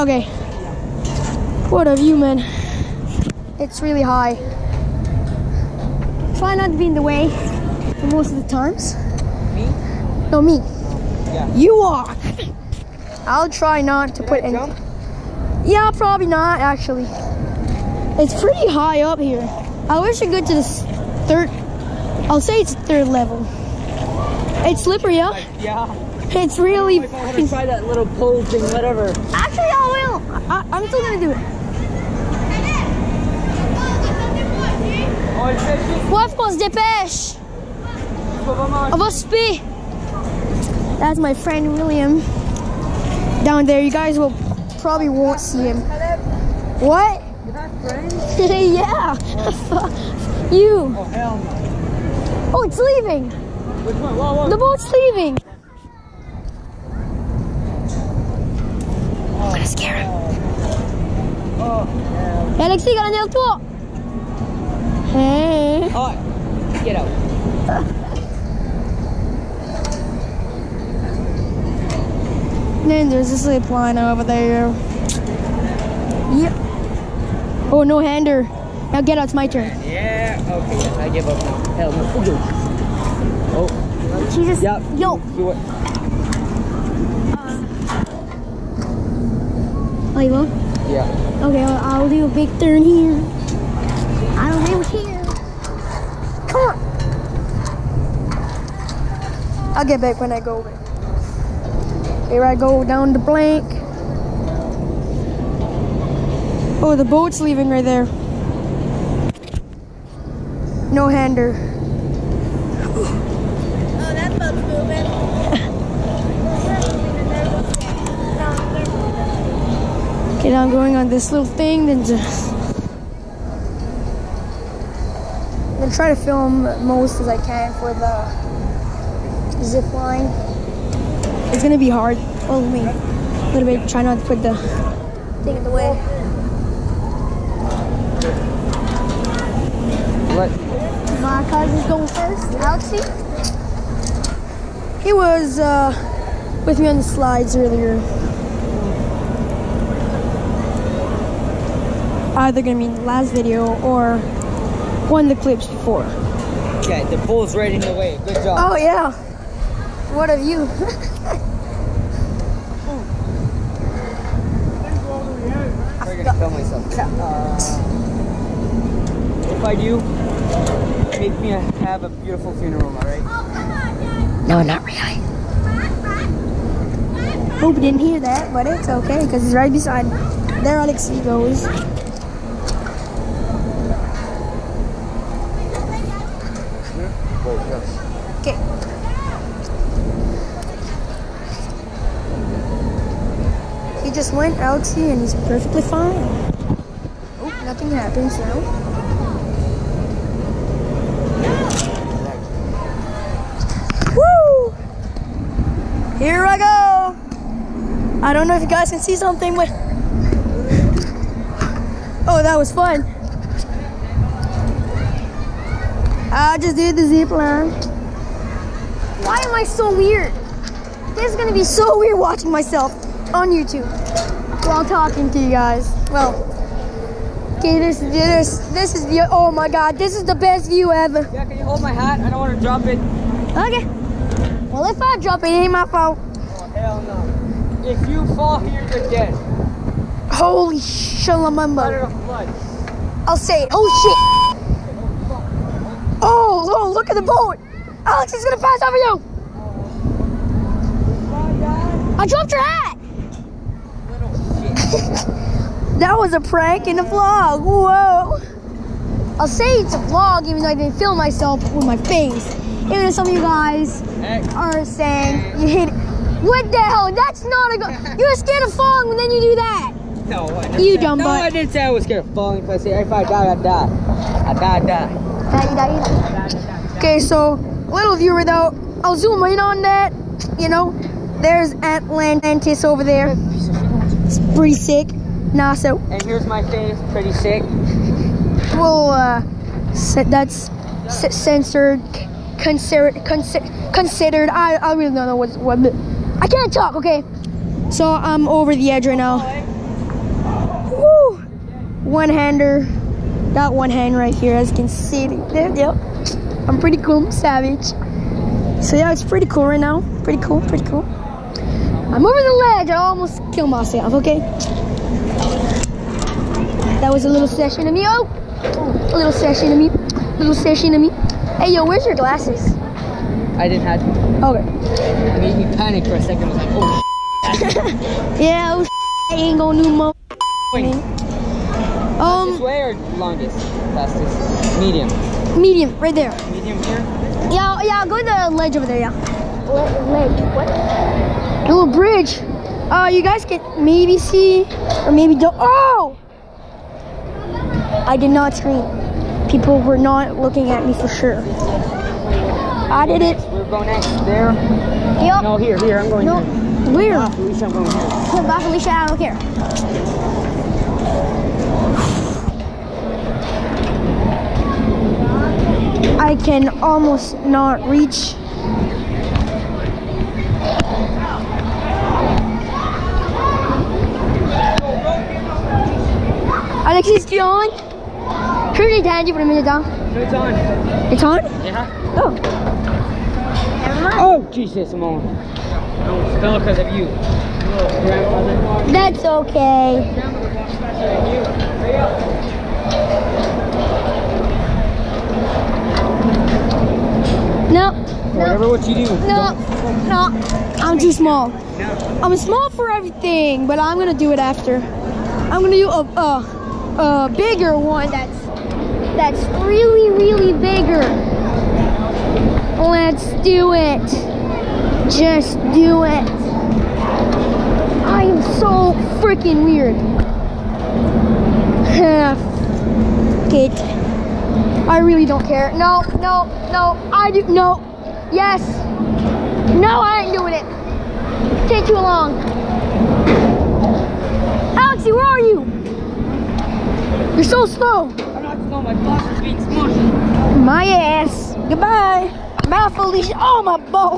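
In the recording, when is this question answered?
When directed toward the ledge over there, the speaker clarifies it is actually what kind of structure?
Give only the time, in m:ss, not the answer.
5:41.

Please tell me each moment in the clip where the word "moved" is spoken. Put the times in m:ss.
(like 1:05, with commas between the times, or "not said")
not said.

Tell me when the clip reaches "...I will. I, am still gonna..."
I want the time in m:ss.
0:29.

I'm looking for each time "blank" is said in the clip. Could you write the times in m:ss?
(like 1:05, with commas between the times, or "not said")
1:43.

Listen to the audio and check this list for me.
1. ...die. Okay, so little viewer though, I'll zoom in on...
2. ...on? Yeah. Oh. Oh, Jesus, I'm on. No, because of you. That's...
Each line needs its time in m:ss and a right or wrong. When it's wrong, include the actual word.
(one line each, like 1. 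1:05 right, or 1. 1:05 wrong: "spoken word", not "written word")
1. 4:36 right
2. 6:21 right.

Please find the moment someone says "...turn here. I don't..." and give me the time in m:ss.
1:32.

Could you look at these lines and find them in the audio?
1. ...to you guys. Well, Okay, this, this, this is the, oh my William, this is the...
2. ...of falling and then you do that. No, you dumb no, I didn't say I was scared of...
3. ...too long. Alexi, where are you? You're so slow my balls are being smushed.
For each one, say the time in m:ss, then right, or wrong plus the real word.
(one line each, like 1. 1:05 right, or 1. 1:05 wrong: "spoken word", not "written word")
1. 3:45 wrong: "God", not "William"
2. 4:28 right
3. 7:11 right.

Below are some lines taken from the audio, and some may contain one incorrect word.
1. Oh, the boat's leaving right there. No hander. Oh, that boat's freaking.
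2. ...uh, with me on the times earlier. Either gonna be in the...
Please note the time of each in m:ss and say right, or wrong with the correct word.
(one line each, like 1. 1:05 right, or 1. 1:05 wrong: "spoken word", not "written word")
1. 1:46 wrong: "moving", not "freaking"
2. 2:25 wrong: "slides", not "times".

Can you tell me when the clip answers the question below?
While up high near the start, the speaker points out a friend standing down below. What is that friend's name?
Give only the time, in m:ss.
0:40.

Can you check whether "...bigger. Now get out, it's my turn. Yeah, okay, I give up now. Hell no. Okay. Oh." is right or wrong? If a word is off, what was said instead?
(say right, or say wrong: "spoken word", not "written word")
wrong: "hander", not "bigger".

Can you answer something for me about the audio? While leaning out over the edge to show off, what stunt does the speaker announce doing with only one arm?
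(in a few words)
One hander.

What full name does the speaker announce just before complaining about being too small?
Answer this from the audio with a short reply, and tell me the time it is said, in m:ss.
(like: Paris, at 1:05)
Alexis Dion, at 6:16.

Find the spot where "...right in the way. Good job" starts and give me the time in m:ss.
2:37.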